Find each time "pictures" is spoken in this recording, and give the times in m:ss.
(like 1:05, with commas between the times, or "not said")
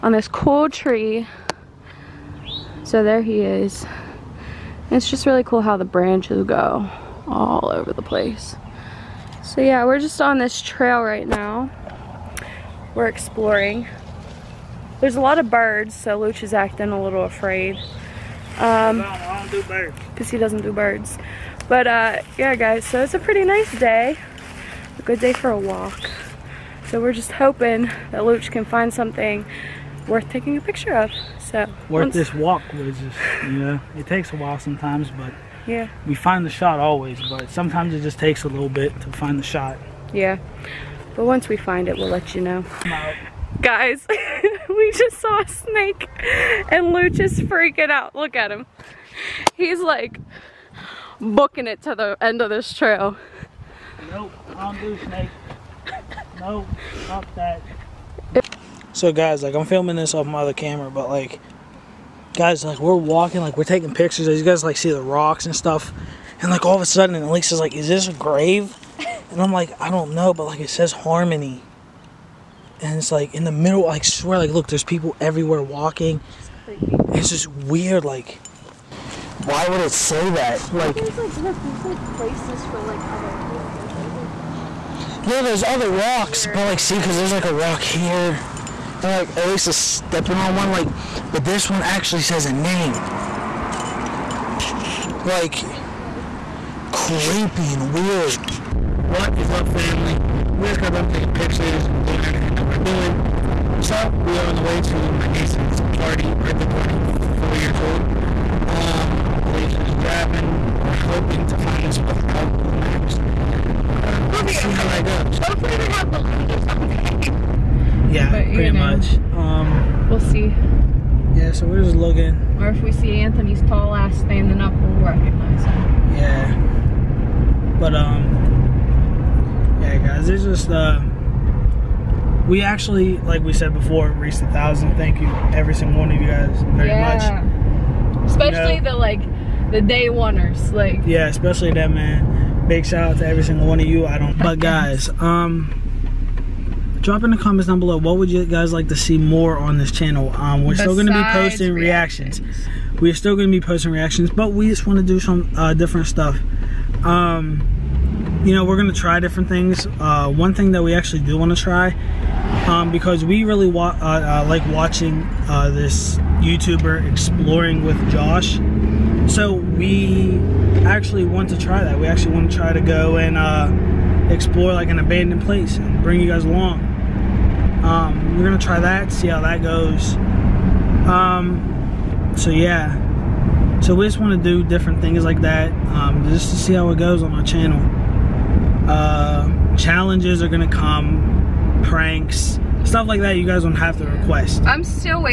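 0:30, 1:03, 1:41.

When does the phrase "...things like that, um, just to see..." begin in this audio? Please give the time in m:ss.
3:05.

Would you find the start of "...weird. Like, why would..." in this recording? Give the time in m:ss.
1:17.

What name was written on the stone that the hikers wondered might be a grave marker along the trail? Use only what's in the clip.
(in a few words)
Harmony.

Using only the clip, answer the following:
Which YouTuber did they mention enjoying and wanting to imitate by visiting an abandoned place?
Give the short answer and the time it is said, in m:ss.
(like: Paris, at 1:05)
Exploring with Josh, at 2:47.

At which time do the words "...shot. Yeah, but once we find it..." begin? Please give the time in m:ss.
0:39.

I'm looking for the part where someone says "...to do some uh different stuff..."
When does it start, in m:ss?
2:34.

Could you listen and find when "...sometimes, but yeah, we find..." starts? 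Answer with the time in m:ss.
0:34.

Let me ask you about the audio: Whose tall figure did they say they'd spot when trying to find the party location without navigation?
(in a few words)
Anthony.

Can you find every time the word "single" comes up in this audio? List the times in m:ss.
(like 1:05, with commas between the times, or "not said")
2:15, 2:23.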